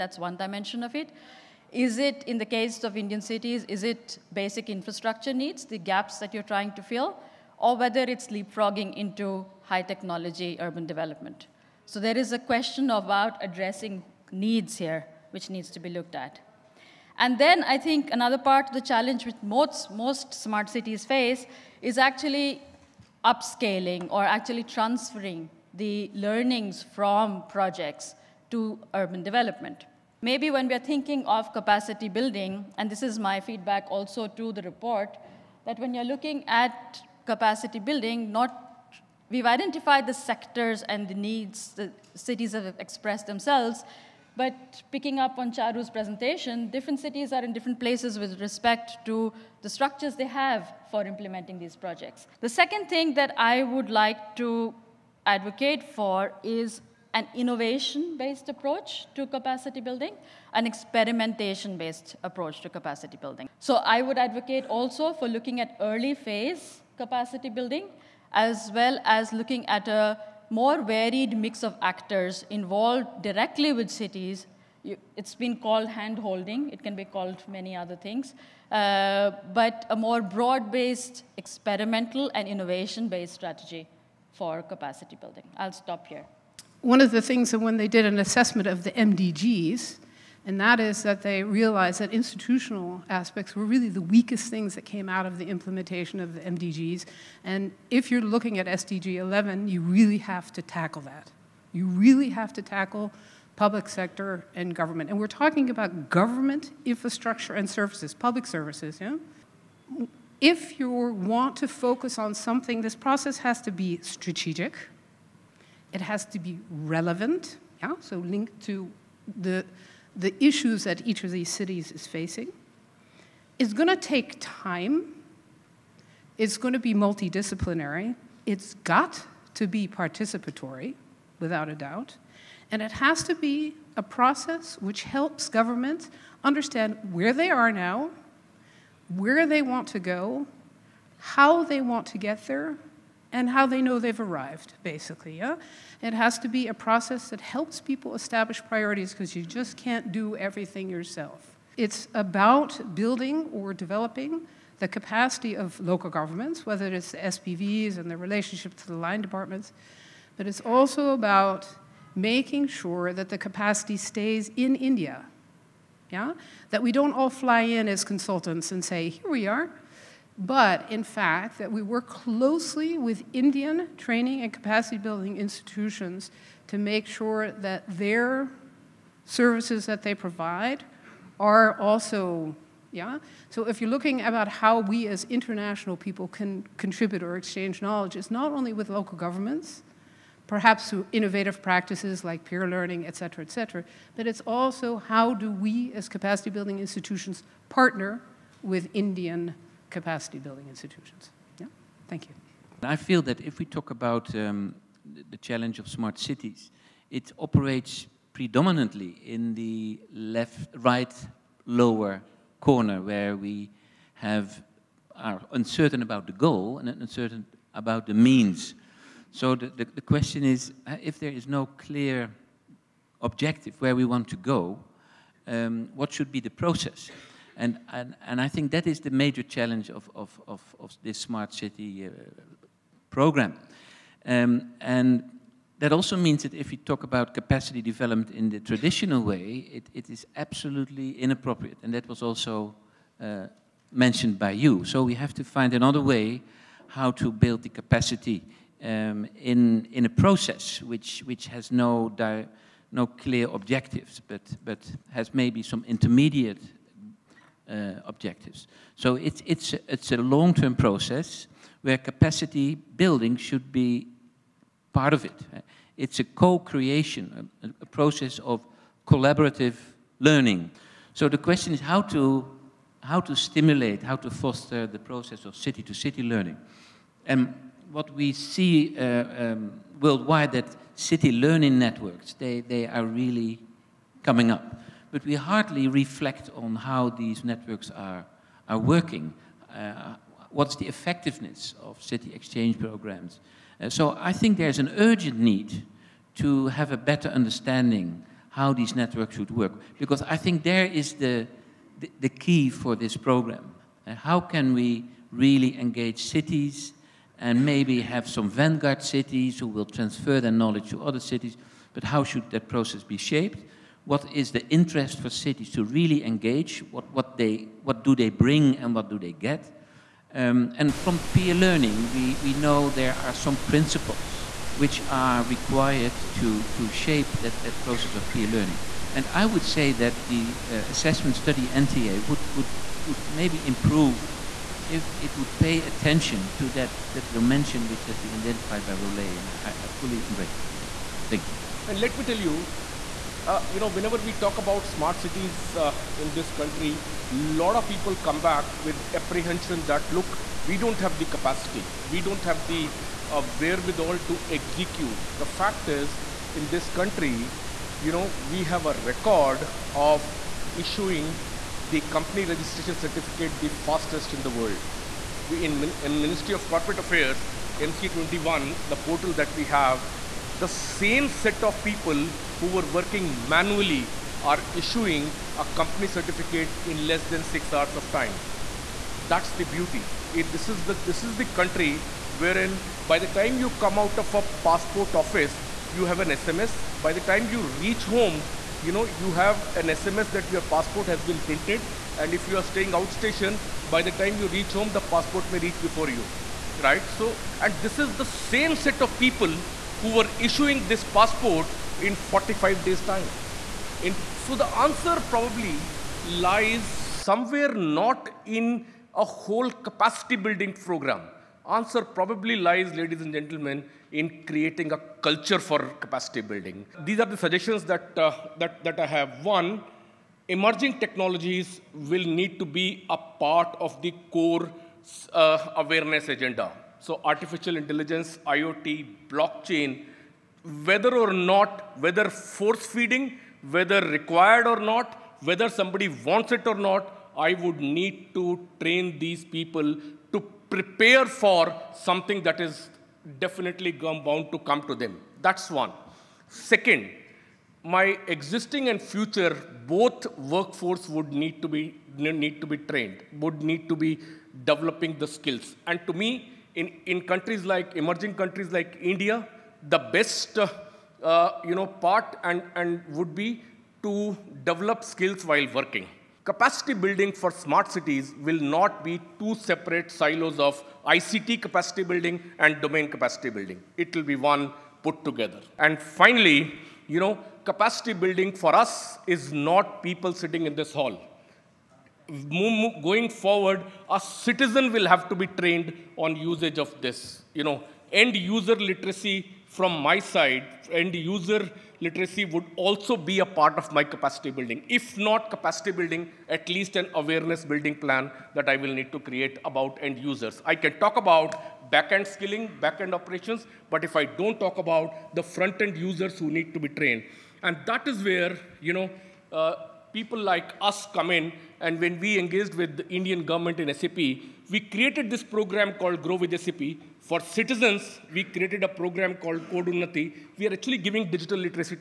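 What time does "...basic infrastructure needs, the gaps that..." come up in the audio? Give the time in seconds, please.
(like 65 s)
4 s.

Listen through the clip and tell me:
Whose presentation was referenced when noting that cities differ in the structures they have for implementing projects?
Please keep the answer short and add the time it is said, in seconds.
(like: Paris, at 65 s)
Charru, at 45 s.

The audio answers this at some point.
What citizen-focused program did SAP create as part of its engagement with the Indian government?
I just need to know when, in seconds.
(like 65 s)
519 s.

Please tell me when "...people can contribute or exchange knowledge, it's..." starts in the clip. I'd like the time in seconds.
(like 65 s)
185 s.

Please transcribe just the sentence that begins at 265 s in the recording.
It's a co-creation, a, a process of collaborative learning.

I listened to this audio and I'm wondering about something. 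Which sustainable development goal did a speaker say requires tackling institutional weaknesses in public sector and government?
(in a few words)
SDG 11.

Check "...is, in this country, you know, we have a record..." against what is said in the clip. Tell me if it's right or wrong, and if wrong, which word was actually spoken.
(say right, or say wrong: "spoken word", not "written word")
right.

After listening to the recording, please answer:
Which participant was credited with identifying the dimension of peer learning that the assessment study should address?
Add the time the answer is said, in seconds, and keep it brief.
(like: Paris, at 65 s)
Rolee, at 338 s.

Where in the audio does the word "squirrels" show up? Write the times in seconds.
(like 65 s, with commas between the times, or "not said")
not said.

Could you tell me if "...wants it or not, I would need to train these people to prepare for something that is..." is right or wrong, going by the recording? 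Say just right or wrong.
right.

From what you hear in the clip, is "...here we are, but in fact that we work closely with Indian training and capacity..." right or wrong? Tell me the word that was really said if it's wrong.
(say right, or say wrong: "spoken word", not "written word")
right.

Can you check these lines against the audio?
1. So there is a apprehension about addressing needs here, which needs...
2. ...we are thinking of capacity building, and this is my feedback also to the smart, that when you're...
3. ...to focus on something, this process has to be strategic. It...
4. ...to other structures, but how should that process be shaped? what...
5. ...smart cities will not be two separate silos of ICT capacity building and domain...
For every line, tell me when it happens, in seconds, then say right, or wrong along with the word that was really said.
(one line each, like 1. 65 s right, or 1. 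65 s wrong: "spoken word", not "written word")
1. 11 s wrong: "question", not "apprehension"
2. 30 s wrong: "report", not "smart"
3. 111 s right
4. 310 s wrong: "cities", not "structures"
5. 467 s right.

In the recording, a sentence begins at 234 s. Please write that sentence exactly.
Um, and that also means that if we talk about capacity development in the traditional way, it, it is absolutely inappropriate.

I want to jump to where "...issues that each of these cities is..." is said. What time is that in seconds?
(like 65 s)
120 s.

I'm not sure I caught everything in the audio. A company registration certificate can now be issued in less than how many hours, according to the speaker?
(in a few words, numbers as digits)
6.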